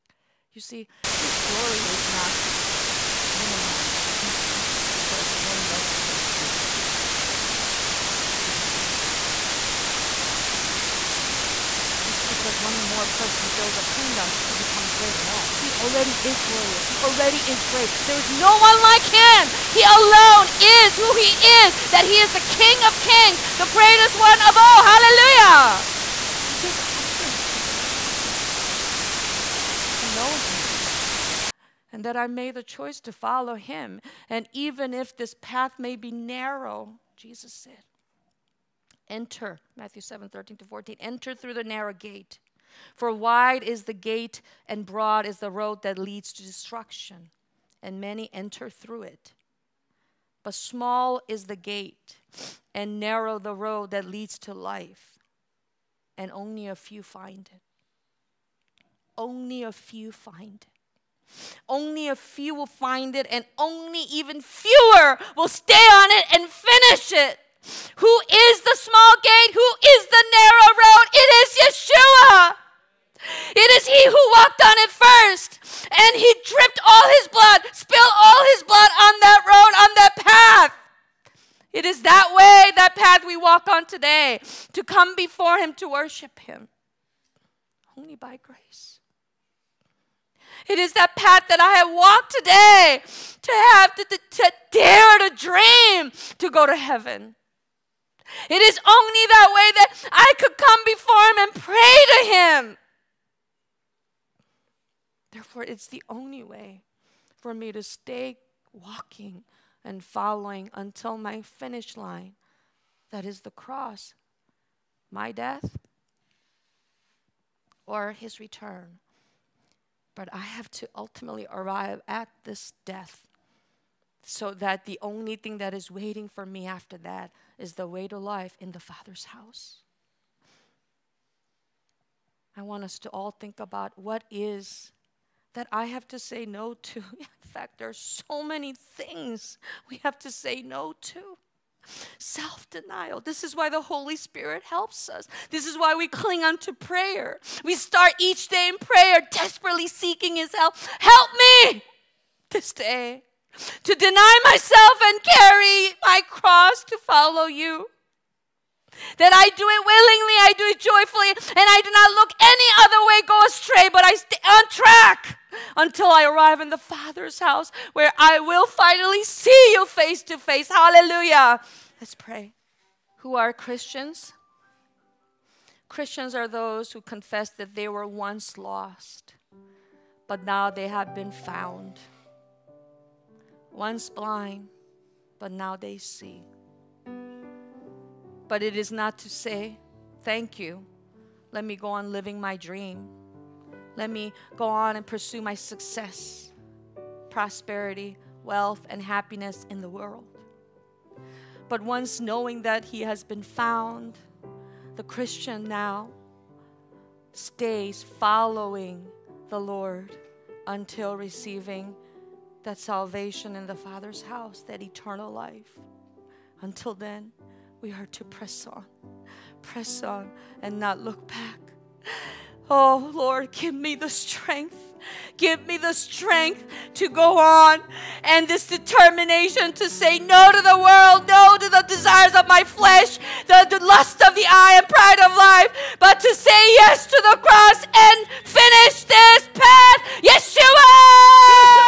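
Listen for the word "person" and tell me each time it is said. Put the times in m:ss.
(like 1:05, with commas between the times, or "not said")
0:05, 0:13.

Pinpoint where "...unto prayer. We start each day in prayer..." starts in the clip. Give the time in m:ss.
2:26.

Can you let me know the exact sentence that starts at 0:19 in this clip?
He alone is who he is, that he is the King of kings, the greatest one of all.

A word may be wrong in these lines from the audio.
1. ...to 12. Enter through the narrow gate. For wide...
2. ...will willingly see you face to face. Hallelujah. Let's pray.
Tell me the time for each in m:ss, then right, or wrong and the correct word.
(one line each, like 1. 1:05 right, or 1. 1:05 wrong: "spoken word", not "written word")
1. 0:40 wrong: "14", not "12"
2. 2:48 wrong: "finally", not "willingly".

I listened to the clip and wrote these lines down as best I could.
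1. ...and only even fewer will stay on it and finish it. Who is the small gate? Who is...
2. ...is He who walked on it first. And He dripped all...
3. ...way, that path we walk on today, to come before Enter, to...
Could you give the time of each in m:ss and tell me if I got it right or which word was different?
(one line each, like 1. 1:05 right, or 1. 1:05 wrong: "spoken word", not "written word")
1. 1:03 right
2. 1:13 right
3. 1:22 wrong: "Him", not "Enter".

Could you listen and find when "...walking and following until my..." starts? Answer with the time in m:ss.
1:48.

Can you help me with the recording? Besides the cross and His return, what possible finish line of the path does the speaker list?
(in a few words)
my death.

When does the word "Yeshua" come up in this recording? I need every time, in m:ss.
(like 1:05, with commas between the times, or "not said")
1:11, 4:00.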